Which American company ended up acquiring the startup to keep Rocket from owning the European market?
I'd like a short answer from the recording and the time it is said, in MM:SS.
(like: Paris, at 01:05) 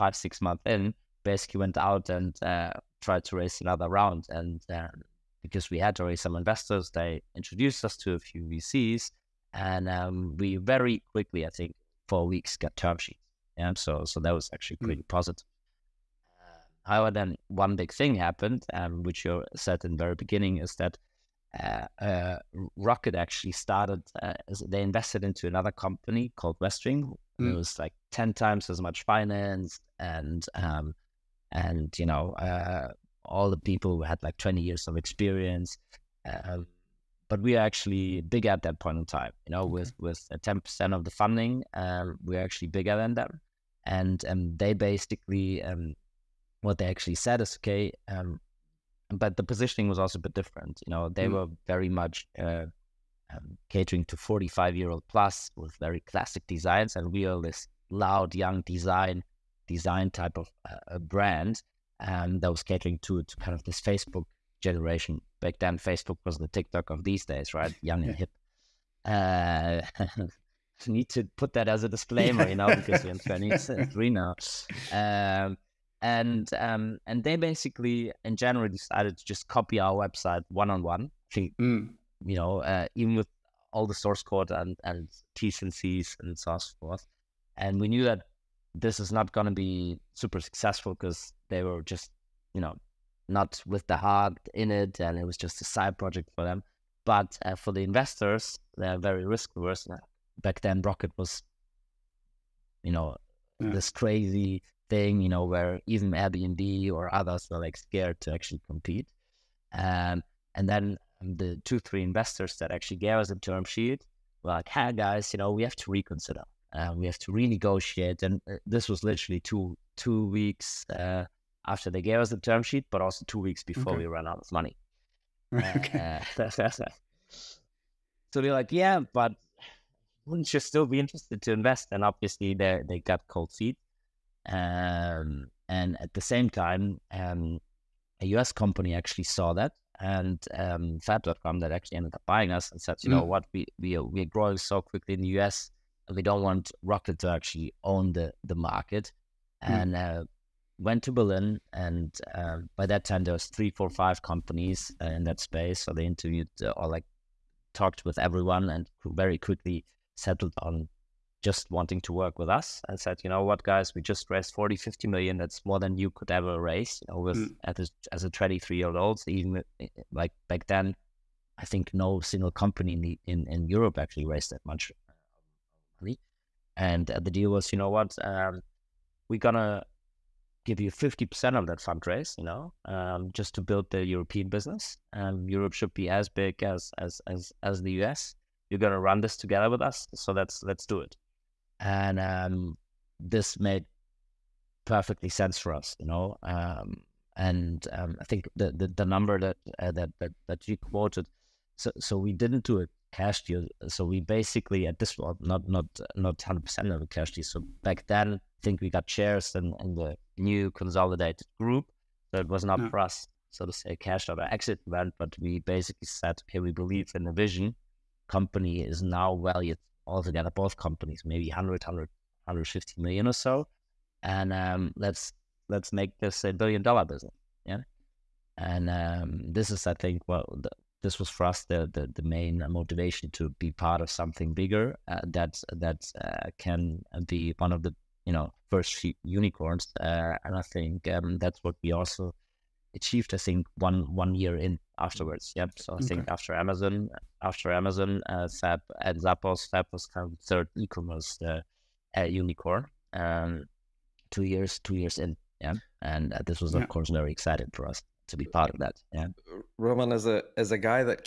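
Fab.com, at 02:20.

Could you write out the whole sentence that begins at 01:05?
Facebook was the TikTok of these days, right?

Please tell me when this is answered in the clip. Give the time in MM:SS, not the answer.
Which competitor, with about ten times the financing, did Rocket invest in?
00:26.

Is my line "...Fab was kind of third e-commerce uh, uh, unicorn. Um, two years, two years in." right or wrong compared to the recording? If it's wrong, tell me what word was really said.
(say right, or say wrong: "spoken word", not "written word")
right.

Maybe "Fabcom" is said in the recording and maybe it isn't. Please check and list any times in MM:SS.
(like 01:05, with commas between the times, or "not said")
02:20.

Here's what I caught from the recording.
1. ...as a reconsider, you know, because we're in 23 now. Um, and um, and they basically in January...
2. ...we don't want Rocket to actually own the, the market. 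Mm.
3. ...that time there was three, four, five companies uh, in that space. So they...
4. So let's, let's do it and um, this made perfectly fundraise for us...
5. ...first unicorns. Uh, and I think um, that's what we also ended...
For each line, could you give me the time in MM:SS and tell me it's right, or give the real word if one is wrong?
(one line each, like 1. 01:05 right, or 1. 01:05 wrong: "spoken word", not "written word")
1. 01:11 wrong: "disclaimer", not "reconsider"
2. 02:26 right
3. 02:32 right
4. 03:10 wrong: "sense", not "fundraise"
5. 03:58 wrong: "achieved", not "ended".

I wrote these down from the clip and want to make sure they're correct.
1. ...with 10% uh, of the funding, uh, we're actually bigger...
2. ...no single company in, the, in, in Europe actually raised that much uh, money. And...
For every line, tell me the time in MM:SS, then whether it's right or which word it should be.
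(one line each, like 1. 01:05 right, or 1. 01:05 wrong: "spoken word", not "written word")
1. 00:39 right
2. 02:51 right.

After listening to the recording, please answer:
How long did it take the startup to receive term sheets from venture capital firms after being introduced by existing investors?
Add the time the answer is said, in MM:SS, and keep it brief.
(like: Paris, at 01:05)
4 weeks, at 00:12.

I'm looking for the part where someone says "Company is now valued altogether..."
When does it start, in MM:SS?
03:38.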